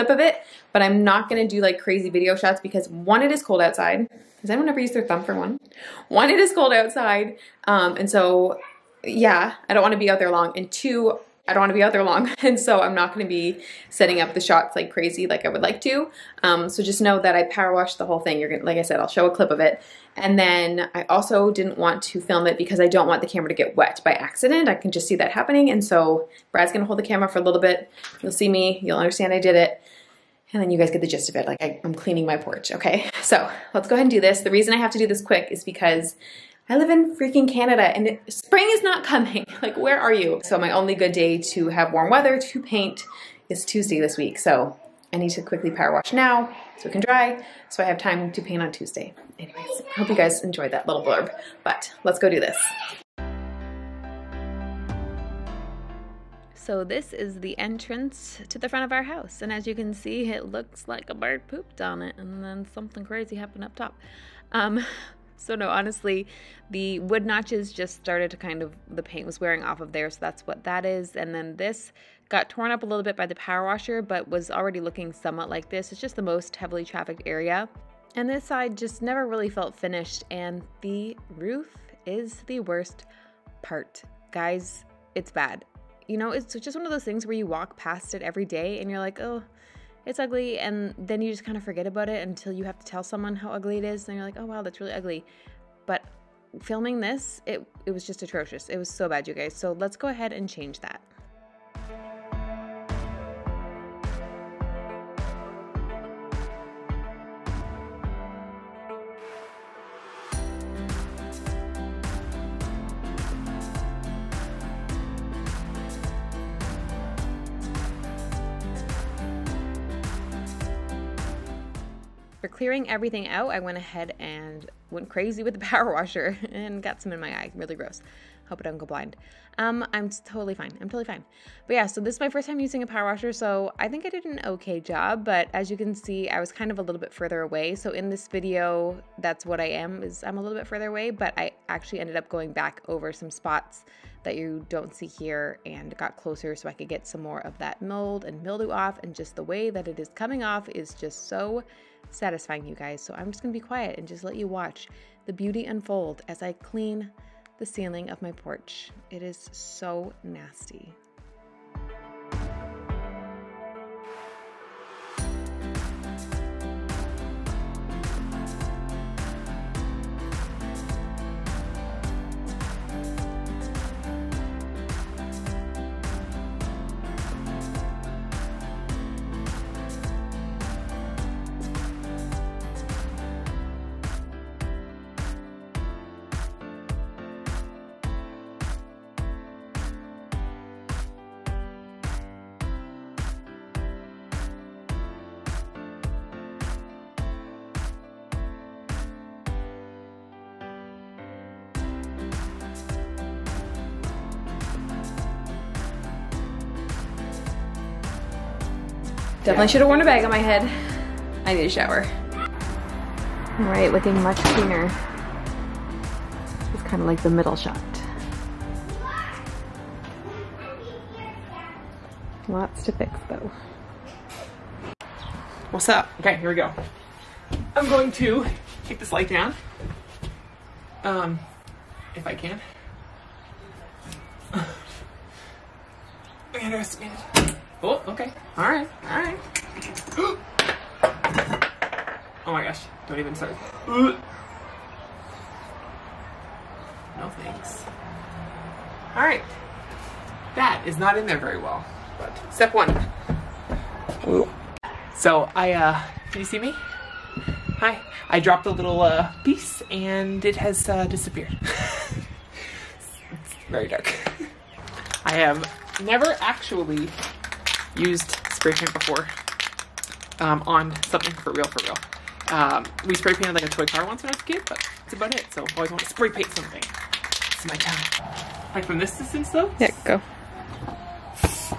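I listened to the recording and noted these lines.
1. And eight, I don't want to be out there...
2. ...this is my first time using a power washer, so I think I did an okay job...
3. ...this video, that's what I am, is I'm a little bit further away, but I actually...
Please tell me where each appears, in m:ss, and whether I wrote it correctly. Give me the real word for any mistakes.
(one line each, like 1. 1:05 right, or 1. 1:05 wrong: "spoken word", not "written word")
1. 0:10 wrong: "two", not "eight"
2. 2:12 right
3. 2:18 right.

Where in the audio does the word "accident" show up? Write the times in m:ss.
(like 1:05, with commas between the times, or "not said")
0:24.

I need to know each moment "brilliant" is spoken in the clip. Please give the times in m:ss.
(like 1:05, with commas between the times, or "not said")
not said.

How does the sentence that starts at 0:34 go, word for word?
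The reason I have to do this quick is because I live in freaking Canada and it, spring is not coming.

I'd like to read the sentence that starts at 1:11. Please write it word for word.
And then this got torn up a little bit by the power washer, but was already looking somewhat like this.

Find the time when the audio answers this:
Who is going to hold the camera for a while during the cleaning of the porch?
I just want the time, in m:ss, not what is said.
0:26.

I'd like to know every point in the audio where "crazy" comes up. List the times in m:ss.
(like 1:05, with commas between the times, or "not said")
0:01, 0:14, 1:03, 2:05.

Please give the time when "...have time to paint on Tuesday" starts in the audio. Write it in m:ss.
0:47.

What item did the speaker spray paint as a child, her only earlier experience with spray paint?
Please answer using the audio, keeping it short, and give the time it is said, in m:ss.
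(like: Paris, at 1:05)
a toy car, at 4:33.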